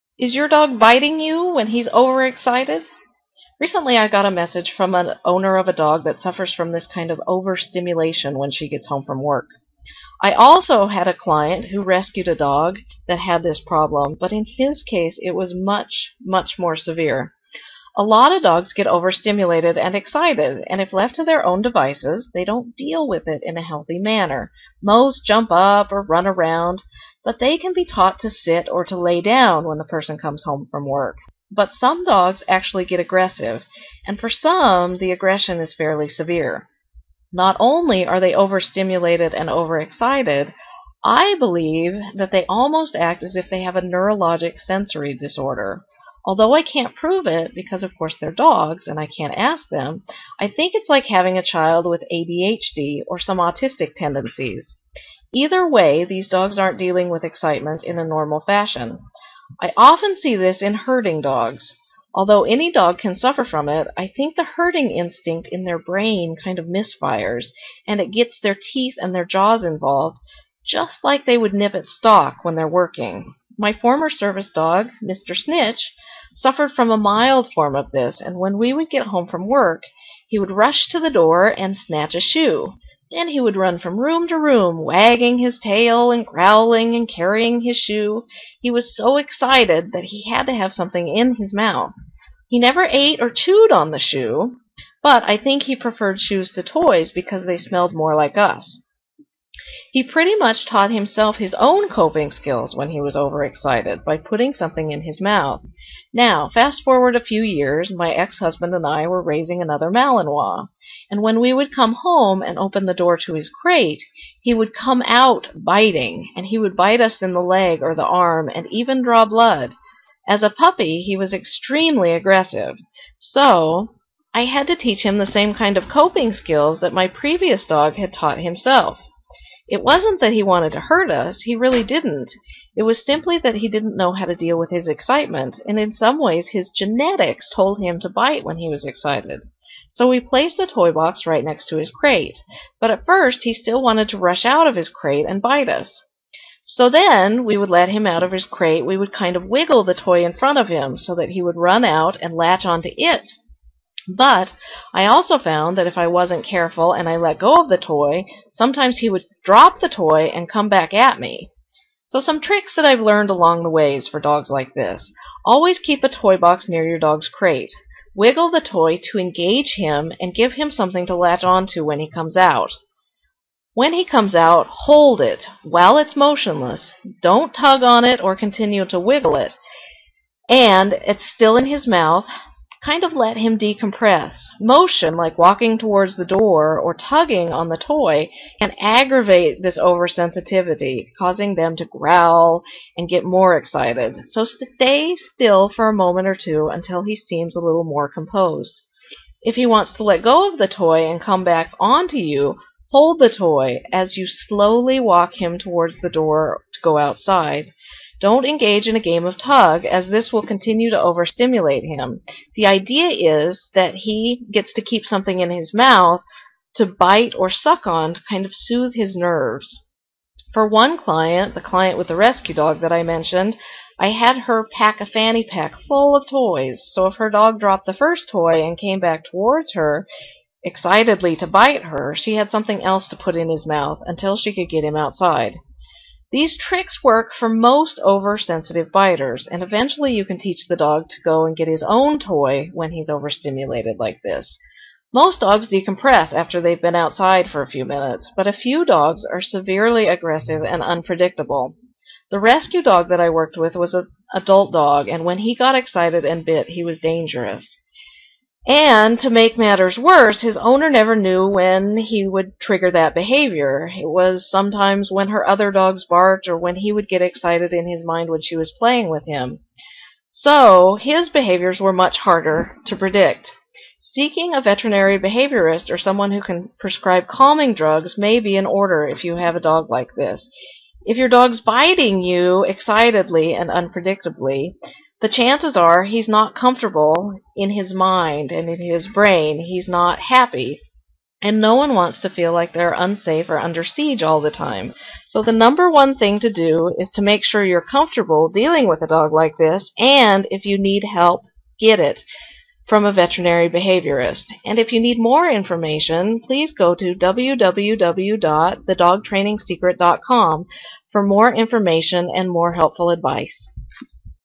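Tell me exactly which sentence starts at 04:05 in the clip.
Most dogs decompress after they've been outside for a few minutes, but a few dogs are severely aggressive and unpredictable.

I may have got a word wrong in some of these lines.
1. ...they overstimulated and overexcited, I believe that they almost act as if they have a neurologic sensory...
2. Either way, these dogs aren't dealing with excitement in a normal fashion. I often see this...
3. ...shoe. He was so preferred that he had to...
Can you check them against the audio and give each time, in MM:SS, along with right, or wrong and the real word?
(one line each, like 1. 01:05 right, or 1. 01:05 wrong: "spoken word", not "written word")
1. 00:38 right
2. 00:55 right
3. 01:27 wrong: "excited", not "preferred".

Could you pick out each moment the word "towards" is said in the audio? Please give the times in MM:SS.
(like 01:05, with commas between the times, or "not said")
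03:05, 03:25, 03:49.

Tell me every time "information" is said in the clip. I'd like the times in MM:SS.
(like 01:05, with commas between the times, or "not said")
05:05, 05:11.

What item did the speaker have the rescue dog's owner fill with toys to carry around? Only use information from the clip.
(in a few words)
fanny pack.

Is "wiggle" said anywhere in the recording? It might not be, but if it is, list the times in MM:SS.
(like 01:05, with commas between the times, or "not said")
02:29, 02:48, 02:58.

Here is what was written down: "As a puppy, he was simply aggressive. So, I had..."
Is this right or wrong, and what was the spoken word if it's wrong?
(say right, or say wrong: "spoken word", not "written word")
wrong: "extremely", not "simply".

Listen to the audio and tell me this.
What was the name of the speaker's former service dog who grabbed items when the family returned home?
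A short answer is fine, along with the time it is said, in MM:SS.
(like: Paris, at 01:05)
Mr. Snitch, at 01:15.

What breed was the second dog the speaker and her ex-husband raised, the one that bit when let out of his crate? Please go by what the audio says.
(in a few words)
Malinois.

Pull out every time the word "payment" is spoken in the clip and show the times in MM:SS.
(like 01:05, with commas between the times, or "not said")
not said.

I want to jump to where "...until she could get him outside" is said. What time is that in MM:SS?
03:54.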